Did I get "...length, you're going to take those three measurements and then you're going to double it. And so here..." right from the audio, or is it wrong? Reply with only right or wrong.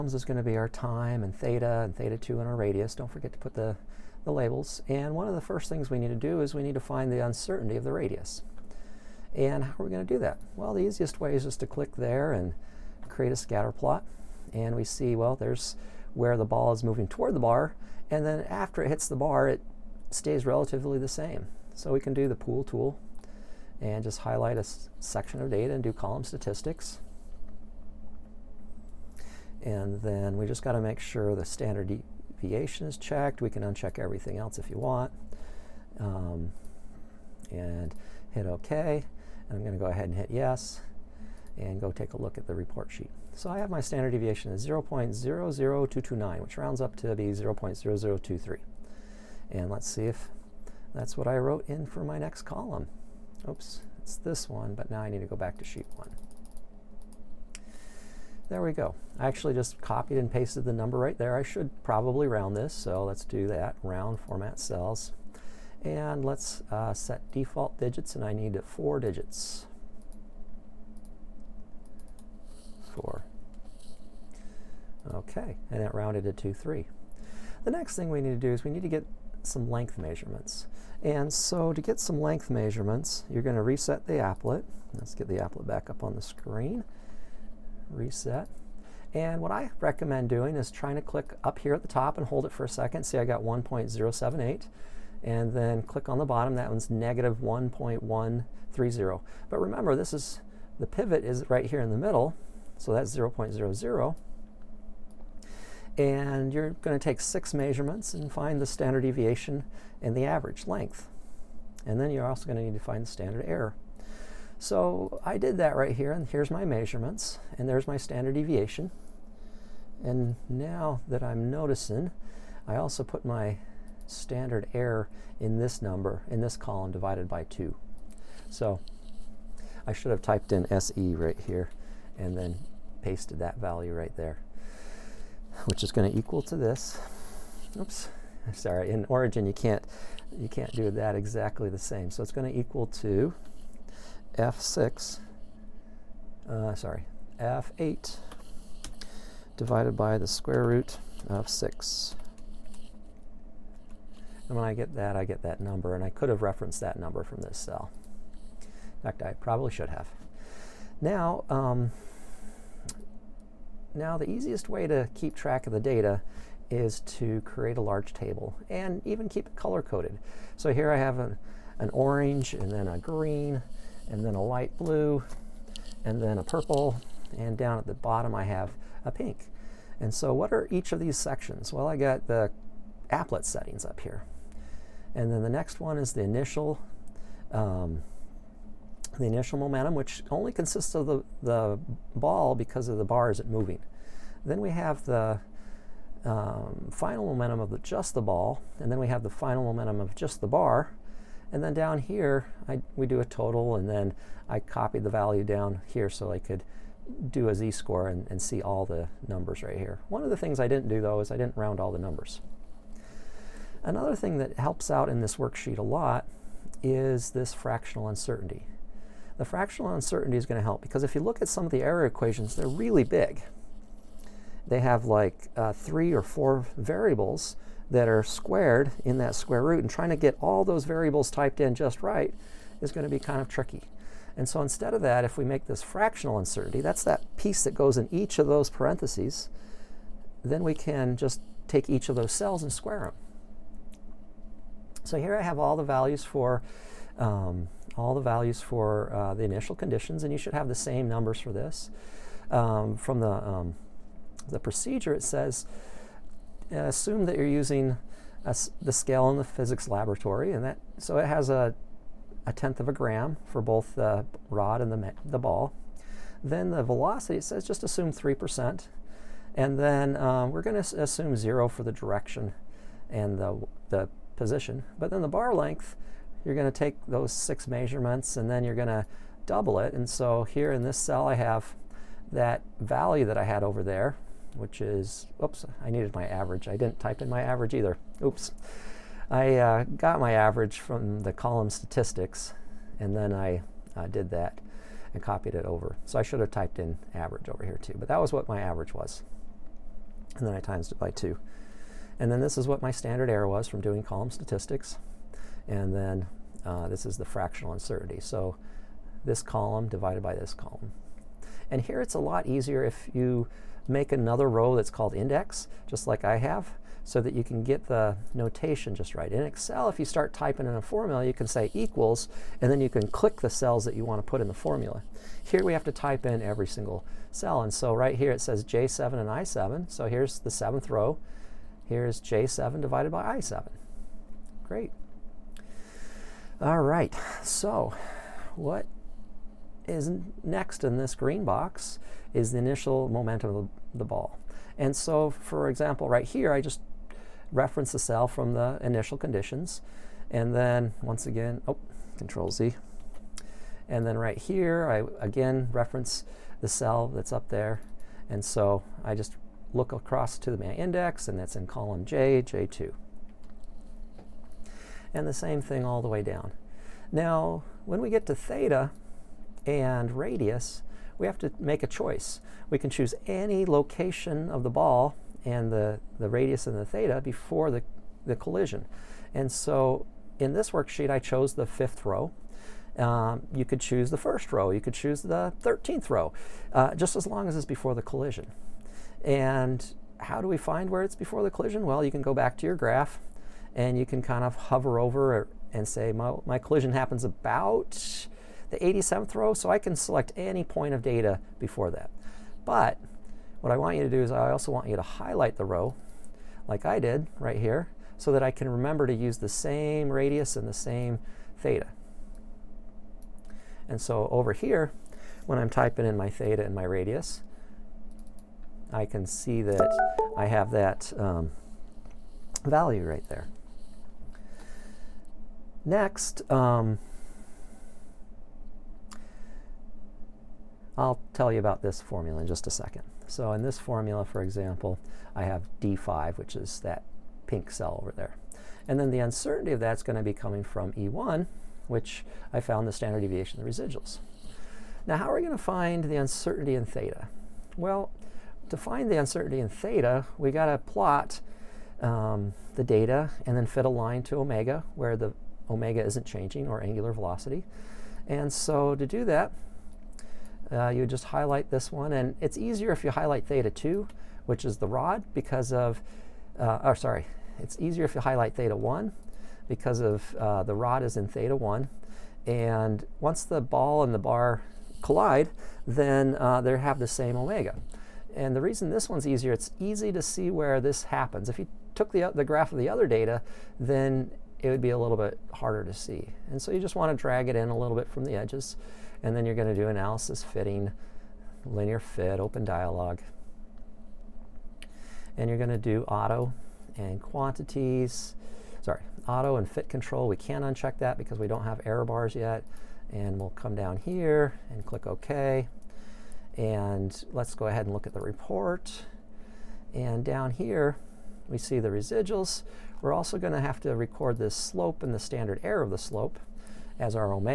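wrong.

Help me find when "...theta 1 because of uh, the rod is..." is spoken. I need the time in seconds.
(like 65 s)
468 s.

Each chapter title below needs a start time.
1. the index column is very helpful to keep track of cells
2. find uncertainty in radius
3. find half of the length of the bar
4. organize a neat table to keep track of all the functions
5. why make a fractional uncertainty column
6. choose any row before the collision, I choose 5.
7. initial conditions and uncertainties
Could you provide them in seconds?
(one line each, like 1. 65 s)
1. 314 s
2. 11 s
3. 78 s
4. 166 s
5. 216 s
6. 381 s
7. 246 s.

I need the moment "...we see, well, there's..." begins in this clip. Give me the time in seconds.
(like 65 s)
14 s.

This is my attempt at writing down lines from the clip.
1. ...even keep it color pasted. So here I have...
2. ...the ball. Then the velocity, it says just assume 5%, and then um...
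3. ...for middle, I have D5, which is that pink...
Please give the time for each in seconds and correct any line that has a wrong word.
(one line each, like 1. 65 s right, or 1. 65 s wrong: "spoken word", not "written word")
1. 169 s wrong: "coded", not "pasted"
2. 265 s wrong: "3", not "5"
3. 434 s wrong: "example", not "middle".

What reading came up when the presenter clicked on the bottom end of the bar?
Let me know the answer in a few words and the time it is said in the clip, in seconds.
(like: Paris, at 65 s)
-1.130, at 96 s.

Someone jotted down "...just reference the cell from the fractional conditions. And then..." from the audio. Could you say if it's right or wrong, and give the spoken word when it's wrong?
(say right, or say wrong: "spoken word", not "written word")
wrong: "initial", not "fractional".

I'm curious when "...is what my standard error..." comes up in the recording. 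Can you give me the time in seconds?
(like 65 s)
302 s.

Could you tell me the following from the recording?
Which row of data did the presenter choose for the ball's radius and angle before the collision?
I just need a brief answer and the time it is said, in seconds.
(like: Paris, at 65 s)
fifth row, at 381 s.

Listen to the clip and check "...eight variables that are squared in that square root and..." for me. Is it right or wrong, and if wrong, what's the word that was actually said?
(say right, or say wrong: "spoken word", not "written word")
wrong: "four", not "eight".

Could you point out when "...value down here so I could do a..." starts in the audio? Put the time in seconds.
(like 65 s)
205 s.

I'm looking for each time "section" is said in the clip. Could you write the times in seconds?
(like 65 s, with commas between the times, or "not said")
24 s, 181 s.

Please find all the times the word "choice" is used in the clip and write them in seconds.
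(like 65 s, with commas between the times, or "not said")
371 s.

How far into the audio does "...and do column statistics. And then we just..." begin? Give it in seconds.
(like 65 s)
25 s.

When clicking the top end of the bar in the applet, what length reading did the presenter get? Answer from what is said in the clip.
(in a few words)
1.078.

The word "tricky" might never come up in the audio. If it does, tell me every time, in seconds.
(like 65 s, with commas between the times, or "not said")
233 s.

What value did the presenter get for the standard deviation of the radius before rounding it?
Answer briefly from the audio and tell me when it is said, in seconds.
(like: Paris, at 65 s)
0.00229, at 44 s.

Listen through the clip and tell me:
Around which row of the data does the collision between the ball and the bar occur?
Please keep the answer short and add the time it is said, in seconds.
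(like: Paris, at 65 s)
87th row, at 398 s.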